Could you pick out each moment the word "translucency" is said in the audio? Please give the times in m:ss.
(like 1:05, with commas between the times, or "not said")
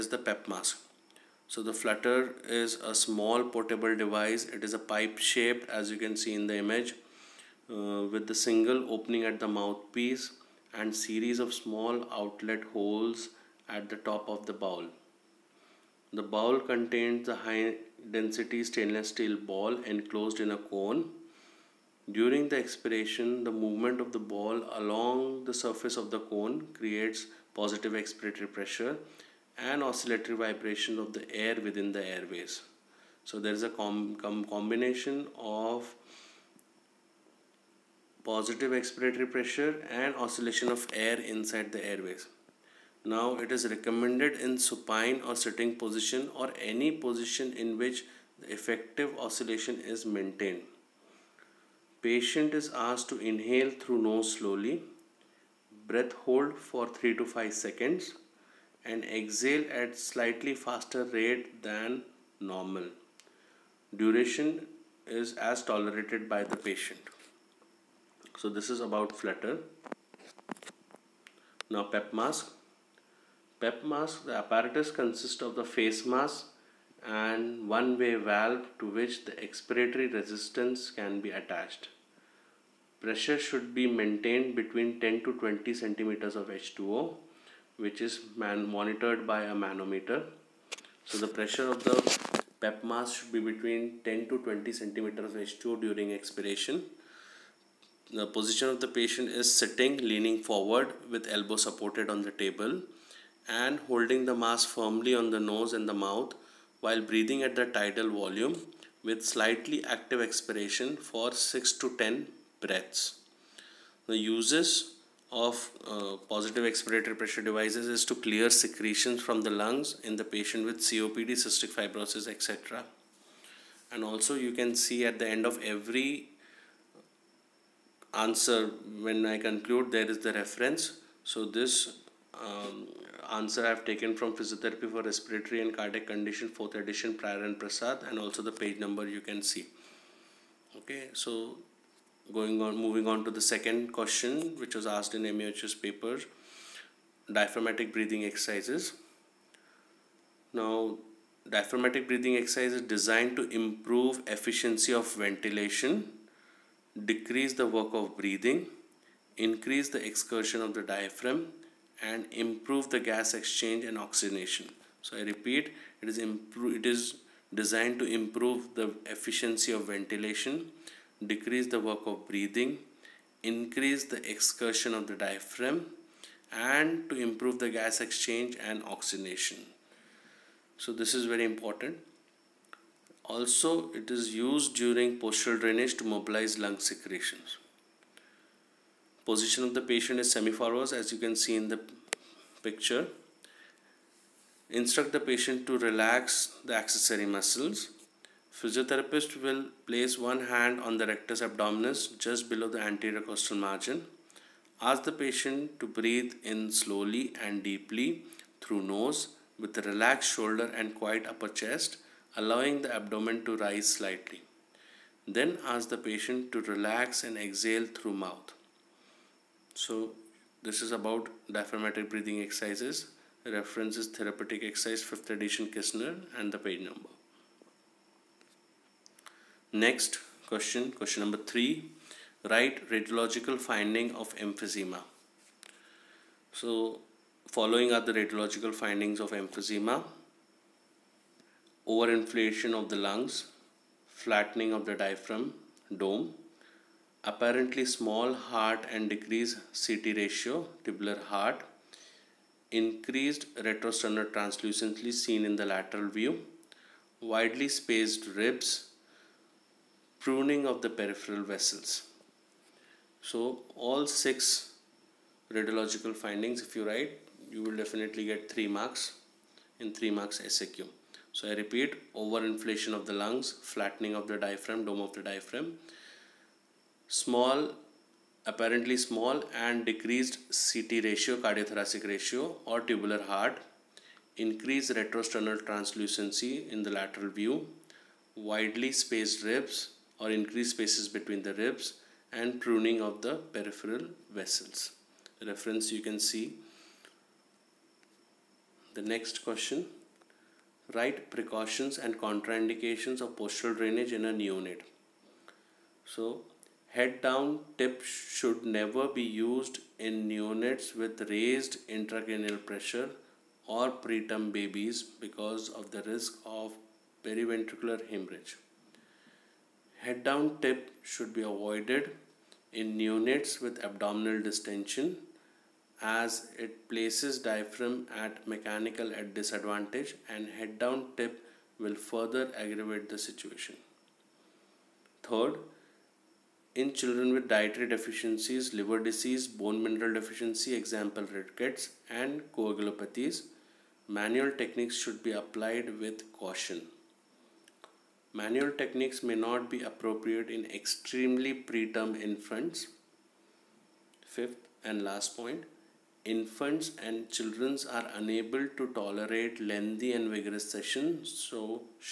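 4:14, 4:45.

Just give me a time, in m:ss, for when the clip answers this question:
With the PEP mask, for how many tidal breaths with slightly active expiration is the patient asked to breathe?
1:51.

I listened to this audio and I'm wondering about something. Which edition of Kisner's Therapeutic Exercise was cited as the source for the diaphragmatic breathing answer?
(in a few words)
5th edition.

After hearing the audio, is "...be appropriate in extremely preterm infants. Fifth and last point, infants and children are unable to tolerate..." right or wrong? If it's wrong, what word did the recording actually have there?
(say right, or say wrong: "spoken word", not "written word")
right.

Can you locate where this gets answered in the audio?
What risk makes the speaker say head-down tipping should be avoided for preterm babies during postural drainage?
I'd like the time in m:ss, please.
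5:17.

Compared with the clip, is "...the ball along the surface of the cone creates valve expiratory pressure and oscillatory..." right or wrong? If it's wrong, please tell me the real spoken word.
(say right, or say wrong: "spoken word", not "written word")
wrong: "positive", not "valve".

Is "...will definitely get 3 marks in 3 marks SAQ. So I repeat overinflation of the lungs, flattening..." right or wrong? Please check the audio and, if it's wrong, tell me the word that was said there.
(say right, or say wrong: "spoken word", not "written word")
right.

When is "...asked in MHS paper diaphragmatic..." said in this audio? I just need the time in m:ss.
2:24.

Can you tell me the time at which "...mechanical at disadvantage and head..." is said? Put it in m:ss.
5:28.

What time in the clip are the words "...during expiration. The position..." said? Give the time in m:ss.
1:35.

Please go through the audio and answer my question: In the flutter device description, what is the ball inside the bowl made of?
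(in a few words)
High density stainless steel.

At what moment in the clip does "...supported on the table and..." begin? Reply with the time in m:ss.
1:41.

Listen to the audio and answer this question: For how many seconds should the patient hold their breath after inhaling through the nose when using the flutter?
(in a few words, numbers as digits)
3 to 5 seconds.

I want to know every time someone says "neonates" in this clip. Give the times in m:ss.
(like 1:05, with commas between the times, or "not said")
5:04, 5:10, 5:22.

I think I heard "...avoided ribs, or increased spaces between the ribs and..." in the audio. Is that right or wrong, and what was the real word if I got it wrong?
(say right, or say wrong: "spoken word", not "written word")
wrong: "spaced", not "avoided".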